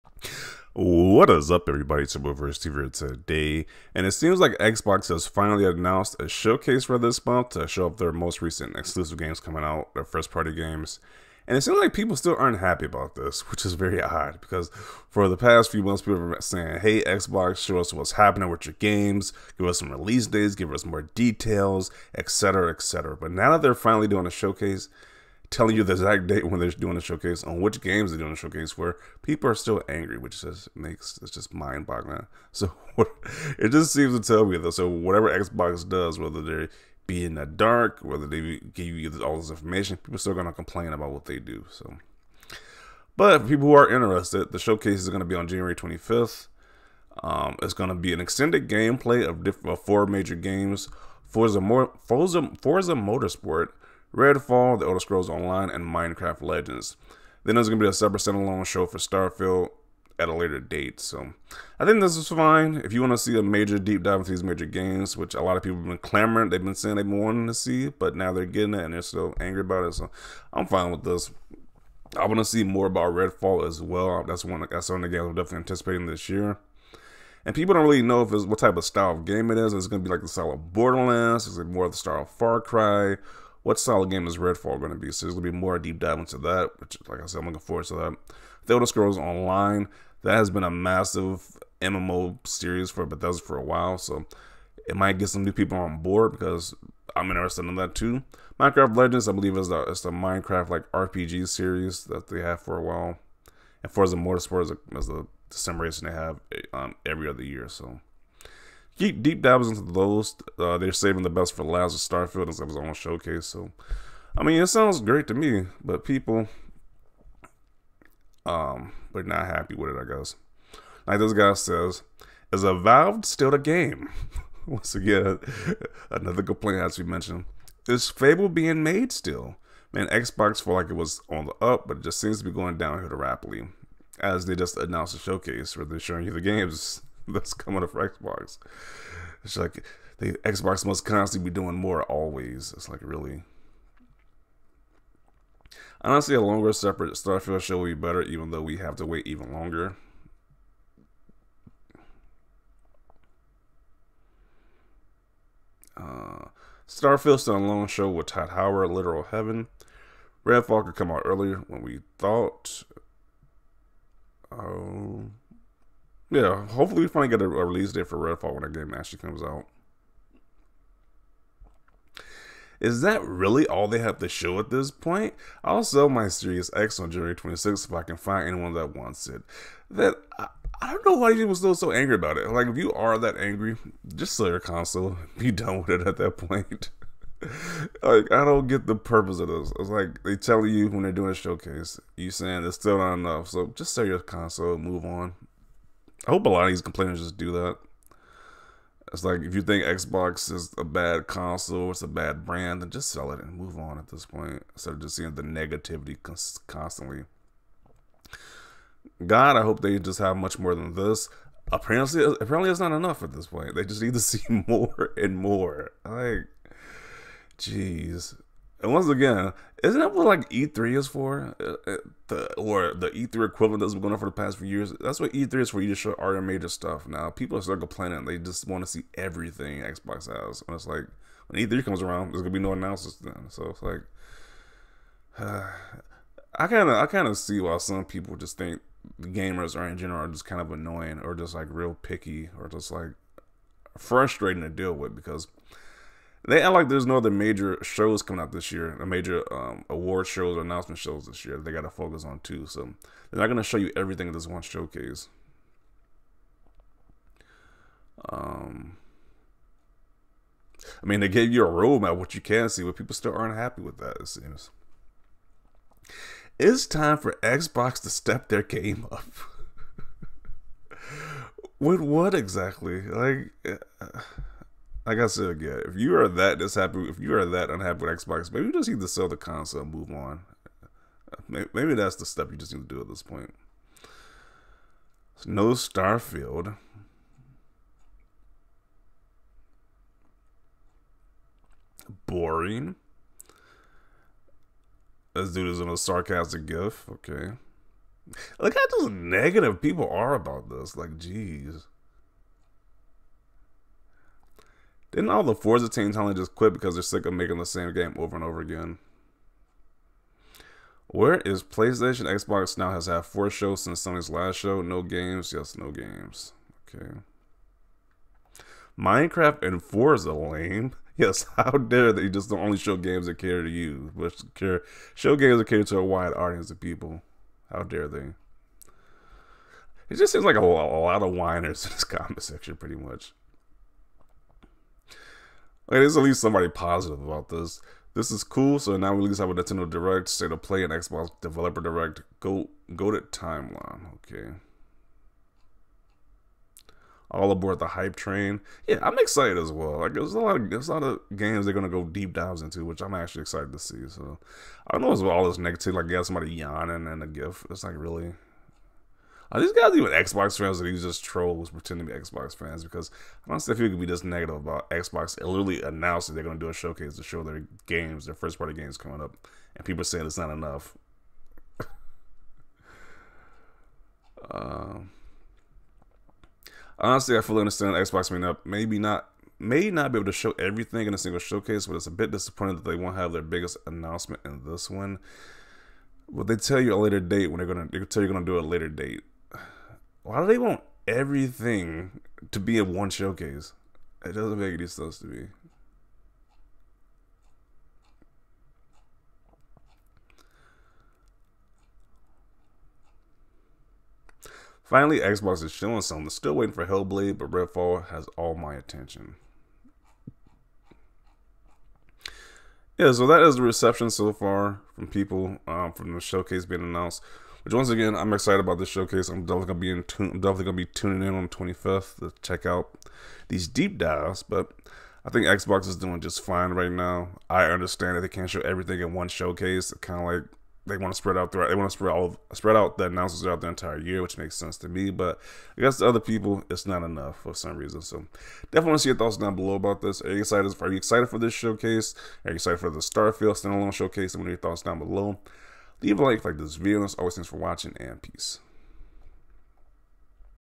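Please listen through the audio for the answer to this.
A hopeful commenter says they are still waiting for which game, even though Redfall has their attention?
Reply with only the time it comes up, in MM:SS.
06:46.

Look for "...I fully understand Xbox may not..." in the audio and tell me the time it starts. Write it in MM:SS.
06:17.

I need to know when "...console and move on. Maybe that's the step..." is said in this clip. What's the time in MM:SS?
04:39.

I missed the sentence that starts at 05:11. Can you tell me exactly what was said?
Where is PlayStation Xbox now has had four shows since Sony's last show?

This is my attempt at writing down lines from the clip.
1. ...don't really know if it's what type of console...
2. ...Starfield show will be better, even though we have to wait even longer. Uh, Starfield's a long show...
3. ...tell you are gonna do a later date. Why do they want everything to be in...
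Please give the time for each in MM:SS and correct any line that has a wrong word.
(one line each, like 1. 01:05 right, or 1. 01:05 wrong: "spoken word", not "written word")
1. 01:17 wrong: "style", not "console"
2. 02:27 right
3. 06:27 right.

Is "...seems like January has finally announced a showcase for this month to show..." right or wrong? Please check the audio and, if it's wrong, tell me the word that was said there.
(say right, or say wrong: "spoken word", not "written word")
wrong: "Xbox", not "January".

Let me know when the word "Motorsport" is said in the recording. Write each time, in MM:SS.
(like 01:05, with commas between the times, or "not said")
00:52, 01:44.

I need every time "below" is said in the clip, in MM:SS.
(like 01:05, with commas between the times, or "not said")
07:19, 07:24.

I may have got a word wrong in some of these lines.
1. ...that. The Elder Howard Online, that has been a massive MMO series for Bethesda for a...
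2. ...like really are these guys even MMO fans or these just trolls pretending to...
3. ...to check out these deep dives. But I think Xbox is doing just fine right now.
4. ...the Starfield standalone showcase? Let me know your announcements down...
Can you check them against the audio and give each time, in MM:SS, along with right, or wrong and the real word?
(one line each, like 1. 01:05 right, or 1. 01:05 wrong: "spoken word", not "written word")
1. 01:27 wrong: "Scrolls", not "Howard"
2. 05:57 wrong: "Xbox", not "MMO"
3. 07:02 right
4. 07:22 wrong: "thoughts", not "announcements".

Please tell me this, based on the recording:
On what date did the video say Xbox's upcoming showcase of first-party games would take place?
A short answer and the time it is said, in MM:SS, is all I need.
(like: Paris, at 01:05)
January 25th, at 00:45.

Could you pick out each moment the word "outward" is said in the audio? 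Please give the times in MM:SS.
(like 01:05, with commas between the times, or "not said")
not said.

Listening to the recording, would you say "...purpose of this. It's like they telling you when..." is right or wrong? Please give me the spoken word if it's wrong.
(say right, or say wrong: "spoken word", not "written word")
right.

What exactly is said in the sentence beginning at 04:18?
Um, I mean, they gave you a roadmap what you can see, but people still aren't happy with that.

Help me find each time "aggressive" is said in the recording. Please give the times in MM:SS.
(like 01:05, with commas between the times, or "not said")
not said.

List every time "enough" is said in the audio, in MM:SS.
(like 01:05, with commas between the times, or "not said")
03:13, 03:32, 06:10, 07:17.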